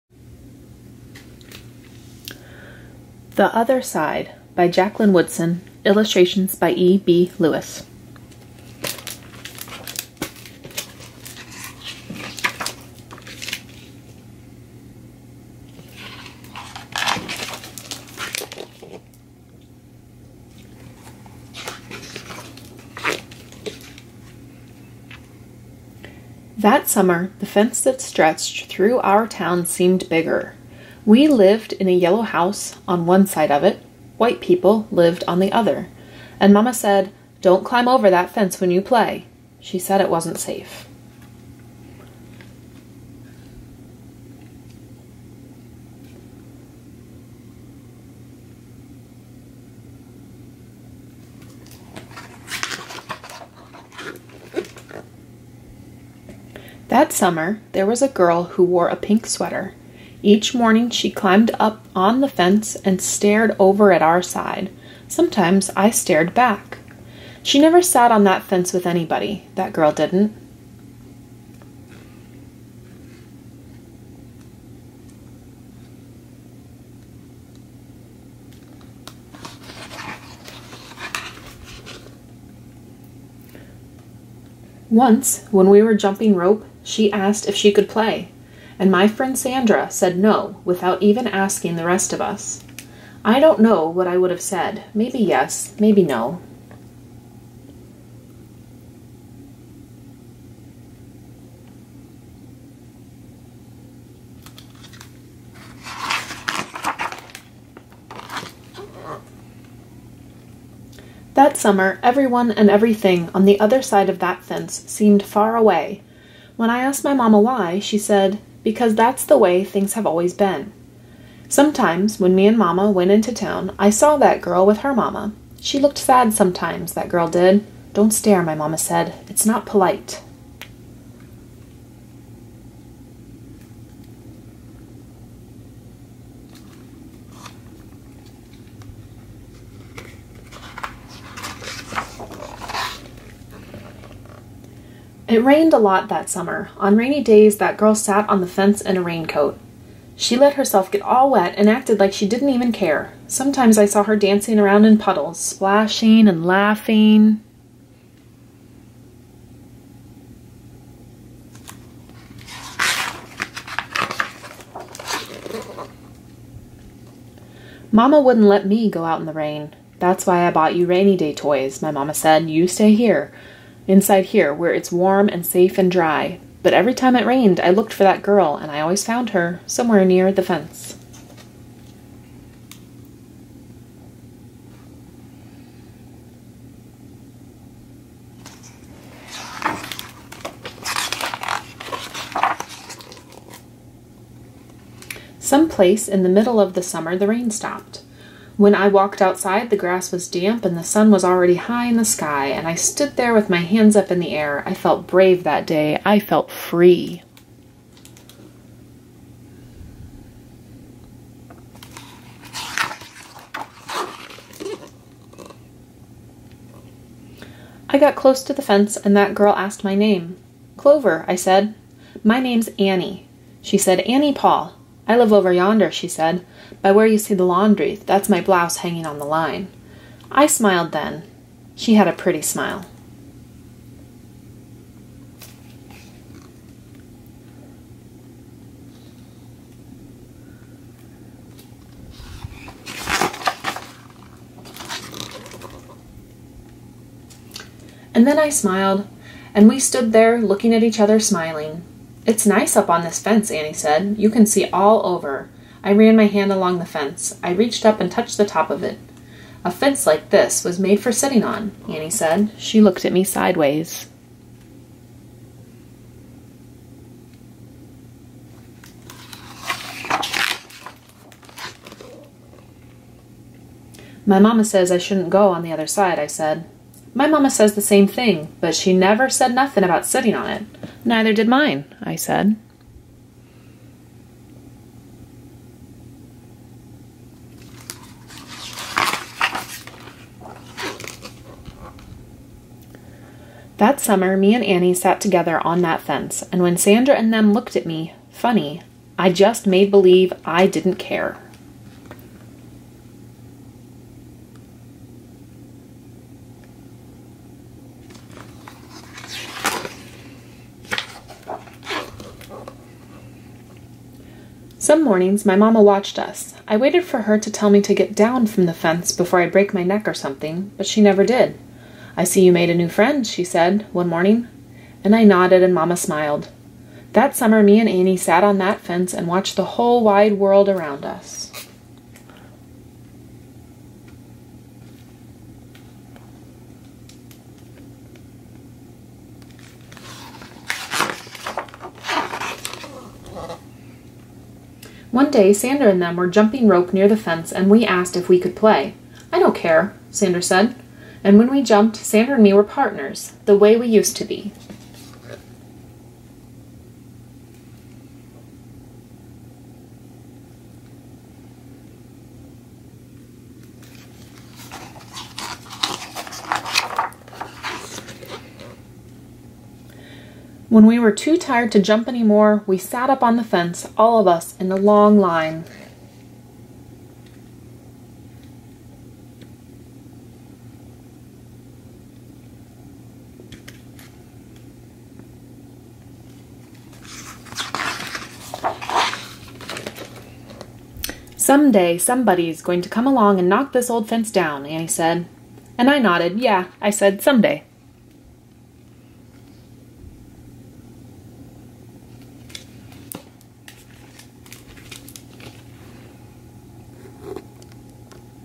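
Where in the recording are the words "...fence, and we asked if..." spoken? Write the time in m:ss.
5:47.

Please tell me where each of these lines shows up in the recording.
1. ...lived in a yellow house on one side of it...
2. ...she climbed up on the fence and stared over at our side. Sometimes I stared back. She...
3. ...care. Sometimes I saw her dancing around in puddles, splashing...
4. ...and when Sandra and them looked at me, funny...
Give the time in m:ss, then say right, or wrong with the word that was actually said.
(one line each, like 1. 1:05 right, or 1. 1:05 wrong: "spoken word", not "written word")
1. 0:31 right
2. 1:00 right
3. 2:32 right
4. 4:56 right.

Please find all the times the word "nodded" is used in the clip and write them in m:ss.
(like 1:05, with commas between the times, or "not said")
5:25, 6:35.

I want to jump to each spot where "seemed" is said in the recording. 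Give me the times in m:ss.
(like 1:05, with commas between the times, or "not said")
0:29, 1:54.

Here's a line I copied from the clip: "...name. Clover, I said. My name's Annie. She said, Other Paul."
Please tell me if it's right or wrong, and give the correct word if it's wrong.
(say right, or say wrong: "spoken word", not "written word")
wrong: "Annie", not "Other".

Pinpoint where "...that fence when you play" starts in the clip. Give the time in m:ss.
0:38.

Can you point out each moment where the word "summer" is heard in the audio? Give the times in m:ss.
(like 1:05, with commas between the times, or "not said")
0:26, 0:57, 1:51, 2:26, 3:16, 4:53, 5:27.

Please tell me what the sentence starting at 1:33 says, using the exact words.
I don't know what I would have said.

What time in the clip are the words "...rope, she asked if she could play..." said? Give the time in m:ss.
1:26.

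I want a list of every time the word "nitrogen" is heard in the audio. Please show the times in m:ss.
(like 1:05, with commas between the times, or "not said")
not said.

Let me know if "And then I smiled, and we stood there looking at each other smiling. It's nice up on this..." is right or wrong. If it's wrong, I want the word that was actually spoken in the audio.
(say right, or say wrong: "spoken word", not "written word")
right.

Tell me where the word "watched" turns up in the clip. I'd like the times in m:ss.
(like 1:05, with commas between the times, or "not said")
5:15, 5:29.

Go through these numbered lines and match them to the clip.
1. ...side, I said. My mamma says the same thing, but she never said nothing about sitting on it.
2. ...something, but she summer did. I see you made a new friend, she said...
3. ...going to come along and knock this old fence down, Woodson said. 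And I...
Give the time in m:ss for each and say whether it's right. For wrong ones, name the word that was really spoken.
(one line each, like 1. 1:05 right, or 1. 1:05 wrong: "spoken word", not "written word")
1. 4:35 right
2. 5:20 wrong: "never", not "summer"
3. 6:32 wrong: "Annie", not "Woodson".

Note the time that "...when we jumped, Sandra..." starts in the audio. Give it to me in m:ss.
5:51.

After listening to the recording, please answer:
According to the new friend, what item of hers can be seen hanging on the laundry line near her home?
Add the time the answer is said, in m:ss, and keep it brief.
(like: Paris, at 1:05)
Blouse, at 3:48.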